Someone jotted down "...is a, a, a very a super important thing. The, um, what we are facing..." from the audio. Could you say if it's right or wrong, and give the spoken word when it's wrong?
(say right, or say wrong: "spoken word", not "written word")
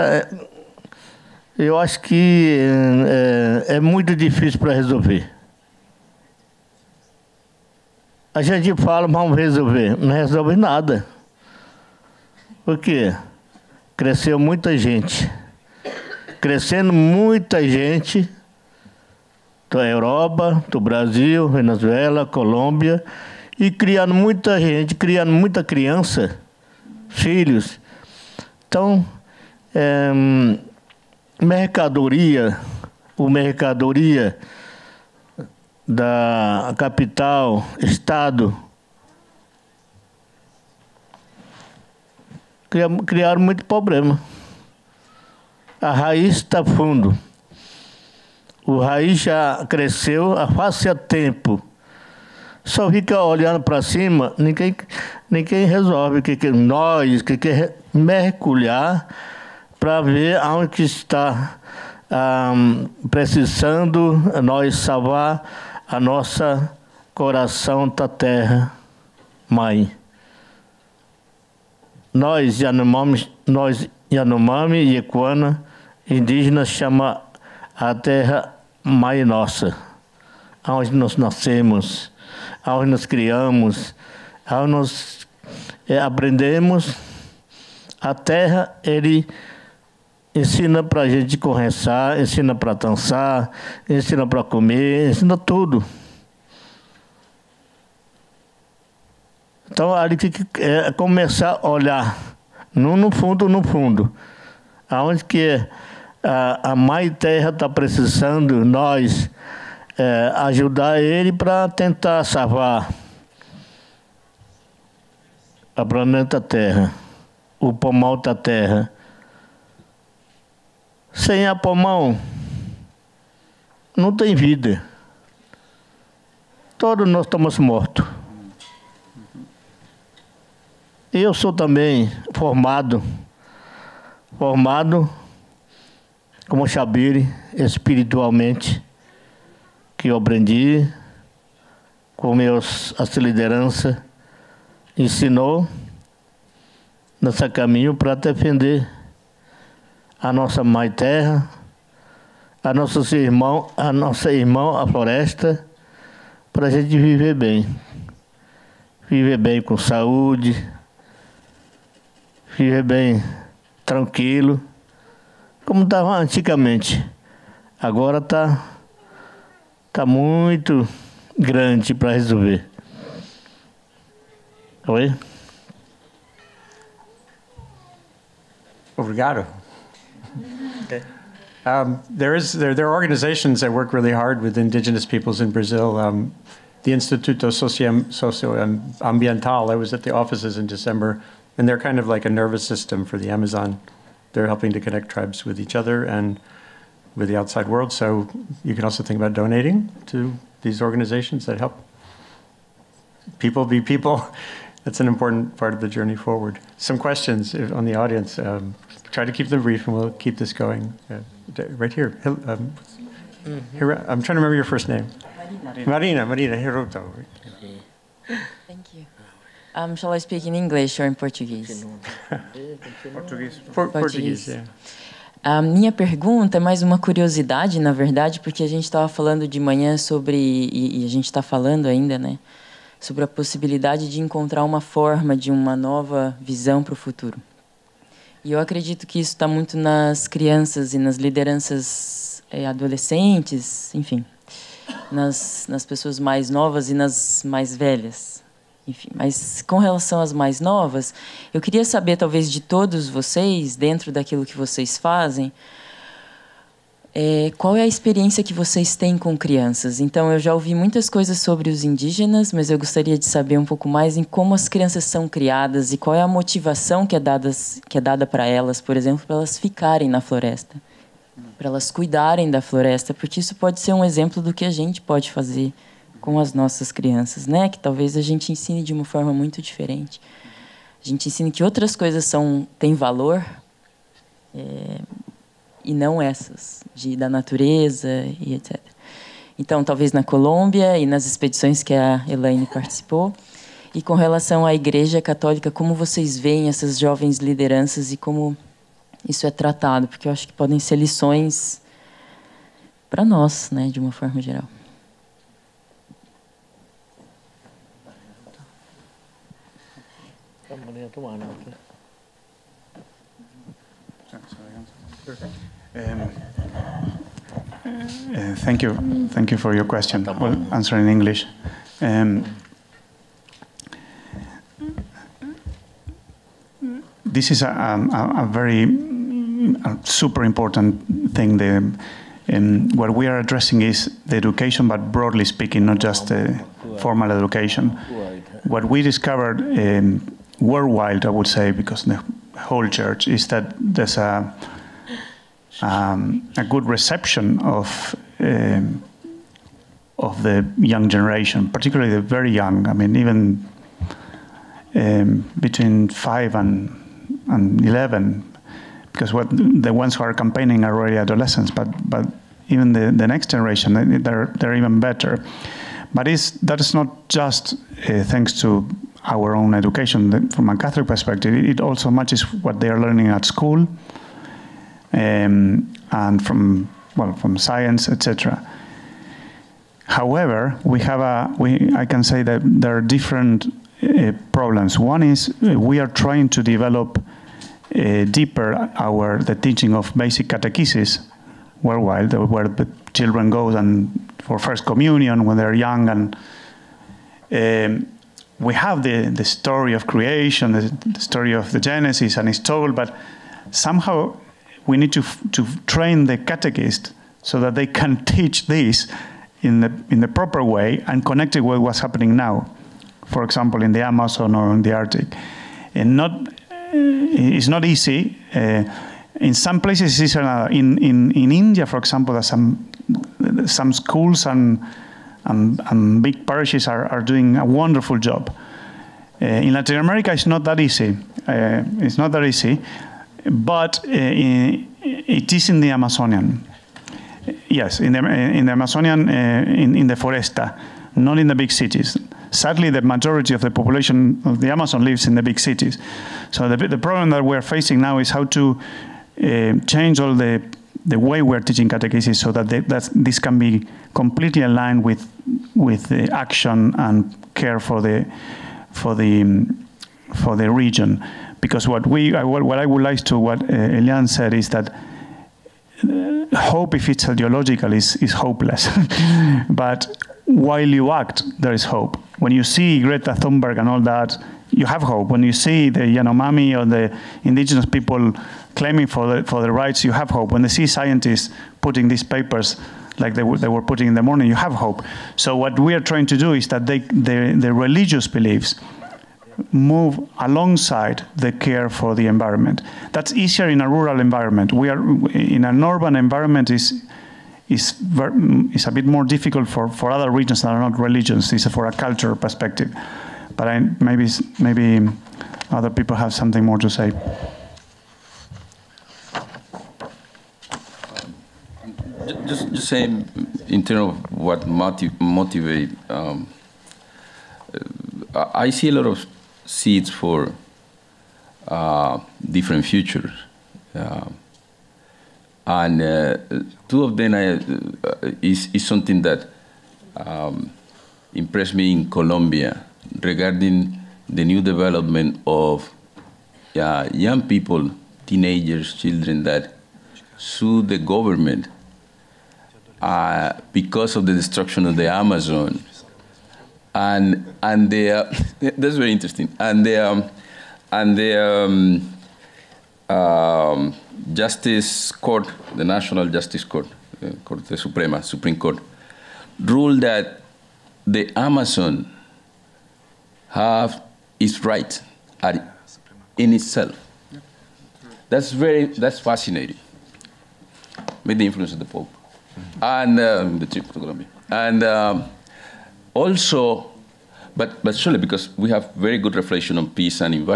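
wrong: "addressing", not "facing".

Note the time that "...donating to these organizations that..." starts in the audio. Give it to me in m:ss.
3:19.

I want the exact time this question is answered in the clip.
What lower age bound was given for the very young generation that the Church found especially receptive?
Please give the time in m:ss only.
5:56.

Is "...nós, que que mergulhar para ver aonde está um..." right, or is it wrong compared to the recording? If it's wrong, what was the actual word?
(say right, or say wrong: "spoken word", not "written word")
right.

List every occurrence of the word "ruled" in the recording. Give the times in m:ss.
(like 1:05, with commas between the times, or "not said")
9:19.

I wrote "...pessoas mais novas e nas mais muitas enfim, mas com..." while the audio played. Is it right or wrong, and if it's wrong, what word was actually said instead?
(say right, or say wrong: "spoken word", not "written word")
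wrong: "velhas", not "muitas".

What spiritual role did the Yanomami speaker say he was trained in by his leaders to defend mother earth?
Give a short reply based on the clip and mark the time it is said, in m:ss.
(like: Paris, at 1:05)
Xabire, at 2:16.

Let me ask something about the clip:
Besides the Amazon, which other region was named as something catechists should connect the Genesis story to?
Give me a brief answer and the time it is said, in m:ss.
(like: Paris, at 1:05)
the Arctic, at 6:54.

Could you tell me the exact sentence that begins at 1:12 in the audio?
Nós Yanomami, nós Yanomami e Equana, indígenas chama a terra mãe nossa, onde nós nascemos Aonde nos criamos, aonde nos eh, aprendemos.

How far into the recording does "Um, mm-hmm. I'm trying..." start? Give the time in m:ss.
3:32.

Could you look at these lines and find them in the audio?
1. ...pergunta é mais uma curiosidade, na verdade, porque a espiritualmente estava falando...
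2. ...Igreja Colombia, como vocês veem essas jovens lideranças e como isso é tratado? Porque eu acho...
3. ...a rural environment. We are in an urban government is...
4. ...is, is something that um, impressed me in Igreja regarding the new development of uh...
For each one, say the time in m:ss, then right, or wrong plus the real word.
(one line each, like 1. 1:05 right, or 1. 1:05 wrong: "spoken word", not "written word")
1. 3:45 wrong: "gente", not "espiritualmente"
2. 4:54 wrong: "Católica", not "Colombia"
3. 8:13 wrong: "environment", not "government"
4. 8:48 wrong: "Colombia", not "Igreja".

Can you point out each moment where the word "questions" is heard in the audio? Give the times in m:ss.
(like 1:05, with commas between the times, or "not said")
3:26, 5:19.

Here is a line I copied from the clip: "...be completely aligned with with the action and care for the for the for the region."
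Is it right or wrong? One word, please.
right.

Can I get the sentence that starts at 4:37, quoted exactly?
Que talvez a gente ensine de uma forma muito diferente.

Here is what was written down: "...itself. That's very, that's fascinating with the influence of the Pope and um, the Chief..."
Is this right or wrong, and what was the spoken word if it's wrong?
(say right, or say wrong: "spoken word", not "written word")
right.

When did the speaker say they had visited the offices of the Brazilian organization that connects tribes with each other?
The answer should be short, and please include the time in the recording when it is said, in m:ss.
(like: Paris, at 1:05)
December, at 3:10.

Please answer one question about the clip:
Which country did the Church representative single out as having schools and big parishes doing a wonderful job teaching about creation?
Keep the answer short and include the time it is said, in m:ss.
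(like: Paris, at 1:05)
India, at 7:01.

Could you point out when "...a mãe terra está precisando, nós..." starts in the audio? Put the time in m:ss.
1:46.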